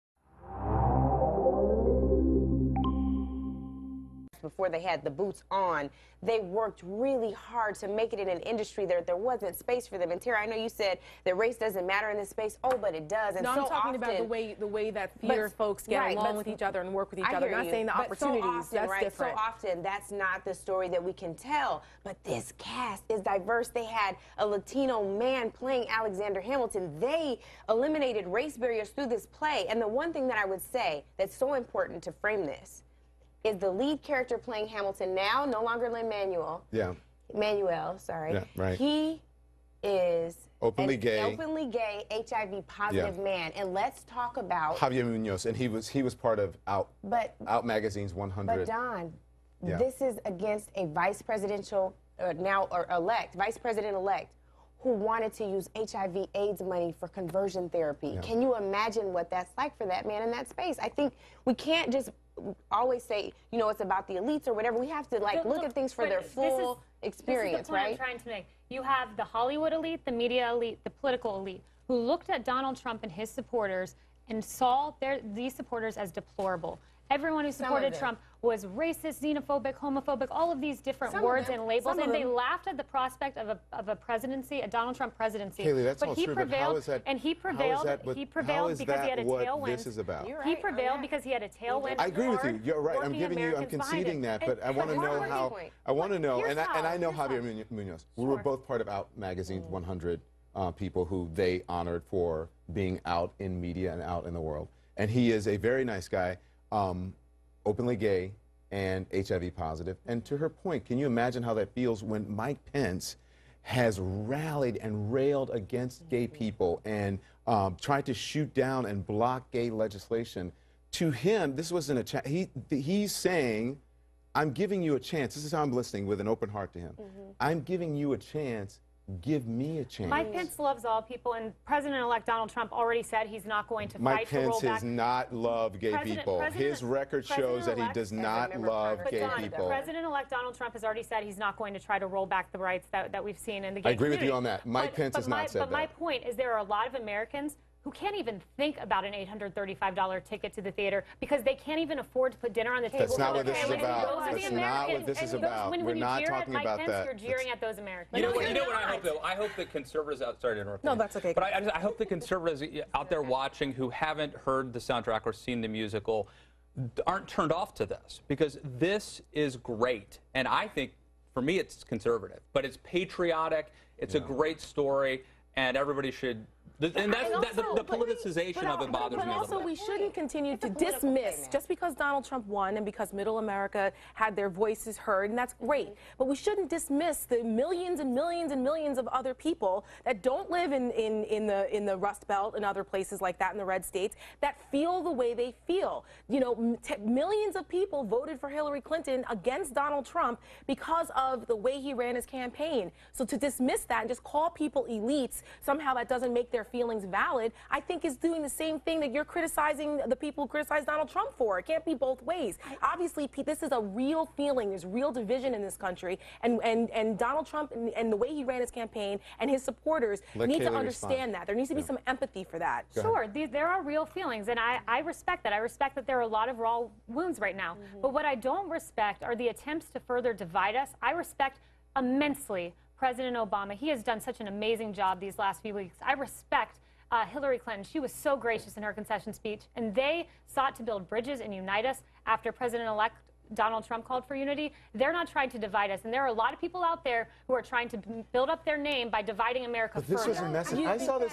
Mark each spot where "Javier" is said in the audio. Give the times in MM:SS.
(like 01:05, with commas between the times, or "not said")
00:44, 01:37.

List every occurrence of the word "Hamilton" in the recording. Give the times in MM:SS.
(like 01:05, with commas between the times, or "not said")
00:26, 00:34.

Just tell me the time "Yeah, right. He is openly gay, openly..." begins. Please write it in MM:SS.
00:38.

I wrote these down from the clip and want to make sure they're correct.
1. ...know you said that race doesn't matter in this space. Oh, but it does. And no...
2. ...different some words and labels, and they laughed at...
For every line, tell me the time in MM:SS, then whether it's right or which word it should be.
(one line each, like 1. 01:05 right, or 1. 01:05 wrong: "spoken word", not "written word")
1. 00:10 right
2. 01:20 right.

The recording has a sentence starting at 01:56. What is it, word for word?
people and um, tried to shoot down and block gay legislation?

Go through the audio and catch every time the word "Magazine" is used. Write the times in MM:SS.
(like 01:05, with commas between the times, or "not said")
00:47, 01:39.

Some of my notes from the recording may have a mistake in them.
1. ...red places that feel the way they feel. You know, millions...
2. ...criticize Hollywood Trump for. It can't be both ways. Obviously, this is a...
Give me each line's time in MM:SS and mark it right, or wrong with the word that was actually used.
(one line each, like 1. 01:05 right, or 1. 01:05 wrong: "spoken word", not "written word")
1. 03:13 wrong: "states", not "places"
2. 03:30 wrong: "Donald", not "Hollywood".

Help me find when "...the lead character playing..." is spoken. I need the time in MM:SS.
00:33.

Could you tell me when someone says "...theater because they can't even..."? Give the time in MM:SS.
02:30.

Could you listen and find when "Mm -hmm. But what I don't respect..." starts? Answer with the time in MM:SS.
03:47.